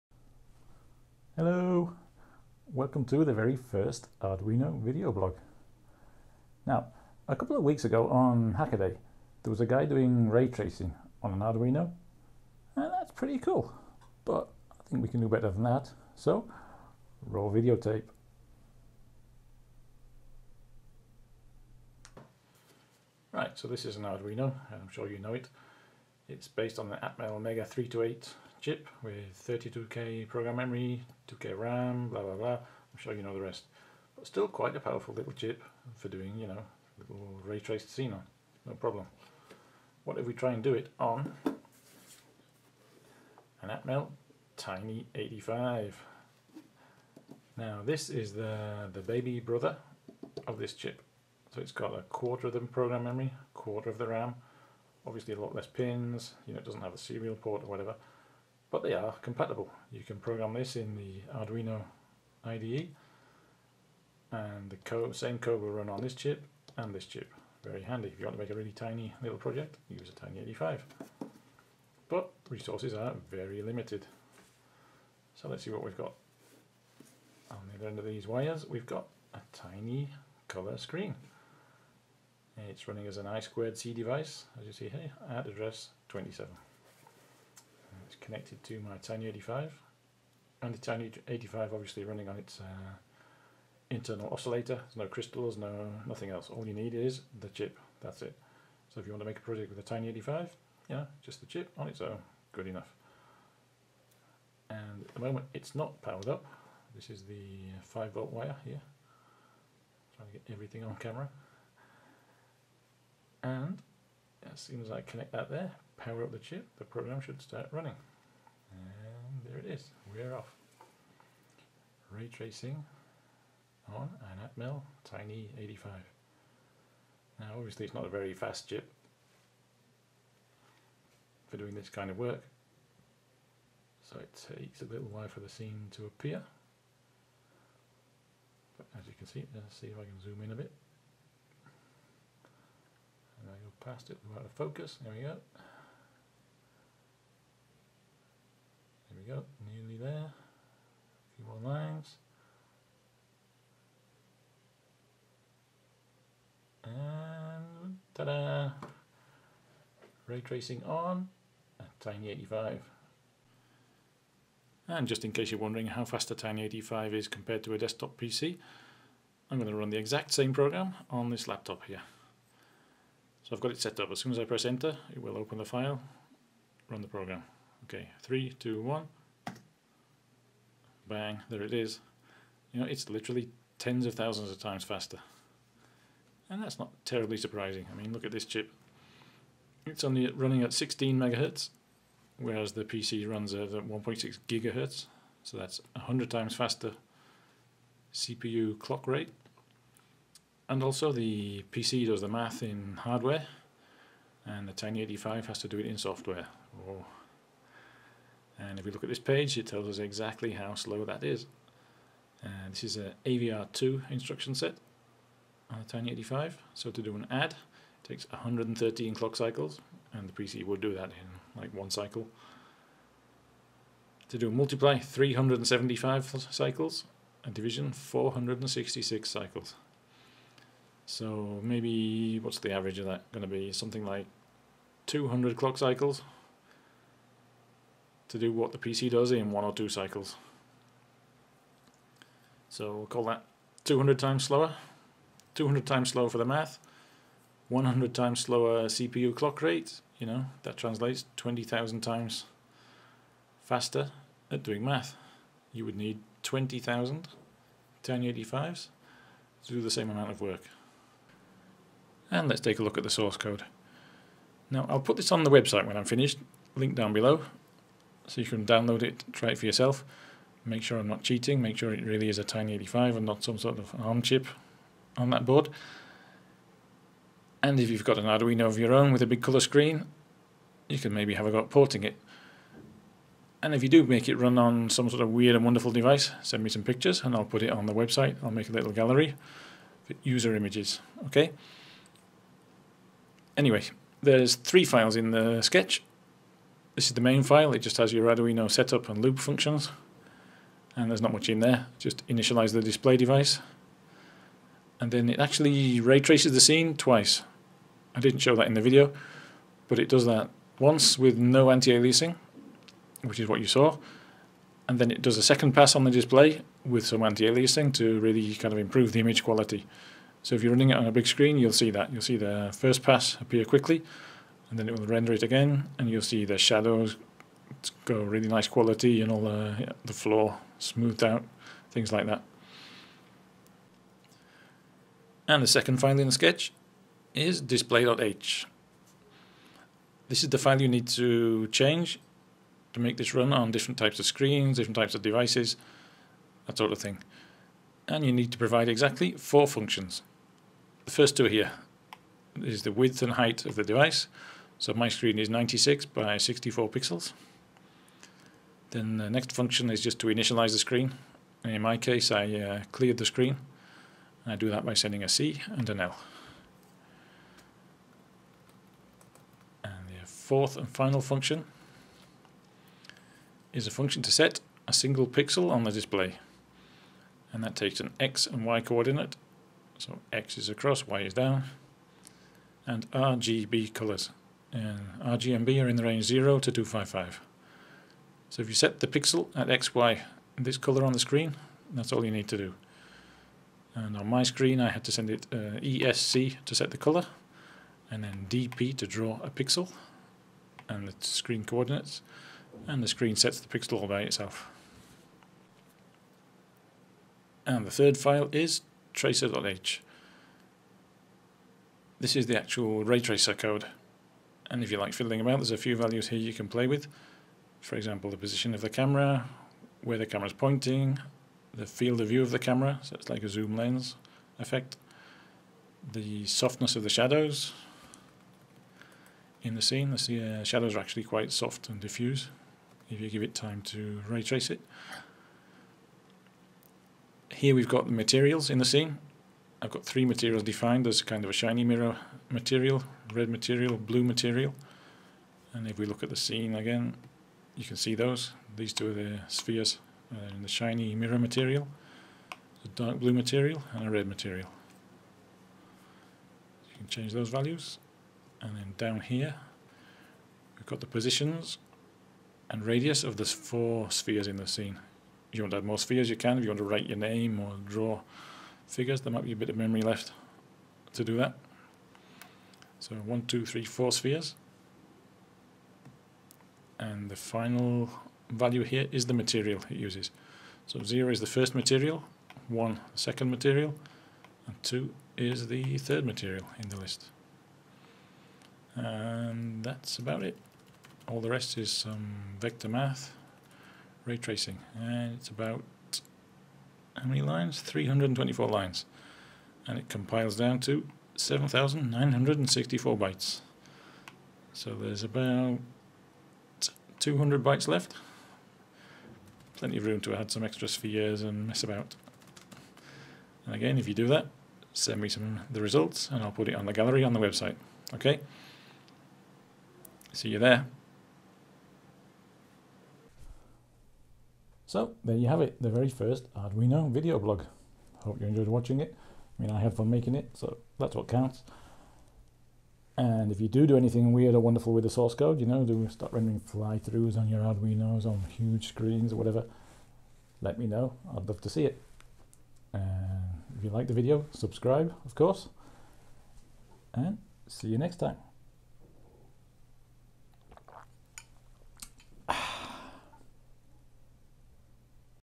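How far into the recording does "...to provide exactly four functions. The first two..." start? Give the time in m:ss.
5:48.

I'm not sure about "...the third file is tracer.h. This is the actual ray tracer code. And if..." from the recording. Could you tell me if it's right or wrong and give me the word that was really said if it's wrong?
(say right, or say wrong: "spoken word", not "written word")
right.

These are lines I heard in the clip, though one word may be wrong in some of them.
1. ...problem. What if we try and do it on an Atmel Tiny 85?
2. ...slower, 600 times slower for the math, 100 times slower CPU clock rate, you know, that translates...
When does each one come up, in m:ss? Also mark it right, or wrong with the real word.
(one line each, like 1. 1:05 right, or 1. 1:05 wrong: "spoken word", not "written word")
1. 0:38 right
2. 4:04 wrong: "200", not "600".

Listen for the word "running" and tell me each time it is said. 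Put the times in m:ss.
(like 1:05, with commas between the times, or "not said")
1:22, 1:32, 1:57, 3:10, 5:20.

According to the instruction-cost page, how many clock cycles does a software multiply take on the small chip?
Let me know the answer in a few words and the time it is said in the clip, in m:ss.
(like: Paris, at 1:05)
375, at 3:44.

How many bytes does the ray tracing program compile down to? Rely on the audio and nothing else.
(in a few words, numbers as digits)
7,964.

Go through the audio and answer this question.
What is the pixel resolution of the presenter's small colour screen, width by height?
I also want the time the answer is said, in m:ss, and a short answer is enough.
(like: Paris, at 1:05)
96 by 64, at 5:55.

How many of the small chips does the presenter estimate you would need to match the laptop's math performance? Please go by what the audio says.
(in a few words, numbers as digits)
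20,000.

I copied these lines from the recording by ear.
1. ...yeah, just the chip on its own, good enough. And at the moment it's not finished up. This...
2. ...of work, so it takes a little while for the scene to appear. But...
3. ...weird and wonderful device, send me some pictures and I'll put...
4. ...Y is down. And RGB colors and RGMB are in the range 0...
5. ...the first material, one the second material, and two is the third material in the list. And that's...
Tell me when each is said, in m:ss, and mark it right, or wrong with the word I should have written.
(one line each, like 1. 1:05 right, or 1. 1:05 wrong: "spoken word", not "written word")
1. 1:40 wrong: "powered", not "finished"
2. 2:12 right
3. 4:45 right
4. 6:21 right
5. 8:01 right.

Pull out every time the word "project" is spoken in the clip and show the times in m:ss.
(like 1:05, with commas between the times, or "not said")
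1:09, 1:39.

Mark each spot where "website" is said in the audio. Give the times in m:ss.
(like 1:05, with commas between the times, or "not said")
4:25, 4:47, 8:37.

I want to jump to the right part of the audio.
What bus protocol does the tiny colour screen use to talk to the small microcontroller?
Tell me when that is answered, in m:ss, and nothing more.
1:23.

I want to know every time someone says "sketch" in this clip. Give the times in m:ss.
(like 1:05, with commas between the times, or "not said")
4:55, 5:36.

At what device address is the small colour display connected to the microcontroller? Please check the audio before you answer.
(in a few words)
27.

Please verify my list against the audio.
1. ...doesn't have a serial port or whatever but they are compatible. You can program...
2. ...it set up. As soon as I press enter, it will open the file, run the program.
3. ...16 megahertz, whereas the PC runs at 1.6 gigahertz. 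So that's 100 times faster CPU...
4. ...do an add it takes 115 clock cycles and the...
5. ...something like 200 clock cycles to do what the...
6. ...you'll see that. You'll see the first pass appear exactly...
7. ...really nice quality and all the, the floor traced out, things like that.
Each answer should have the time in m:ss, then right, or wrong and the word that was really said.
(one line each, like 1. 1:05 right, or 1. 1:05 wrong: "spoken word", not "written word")
1. 0:56 right
2. 2:53 right
3. 3:10 right
4. 3:37 wrong: "113", not "115"
5. 3:53 right
6. 5:21 wrong: "quickly", not "exactly"
7. 5:28 wrong: "smoothed", not "traced".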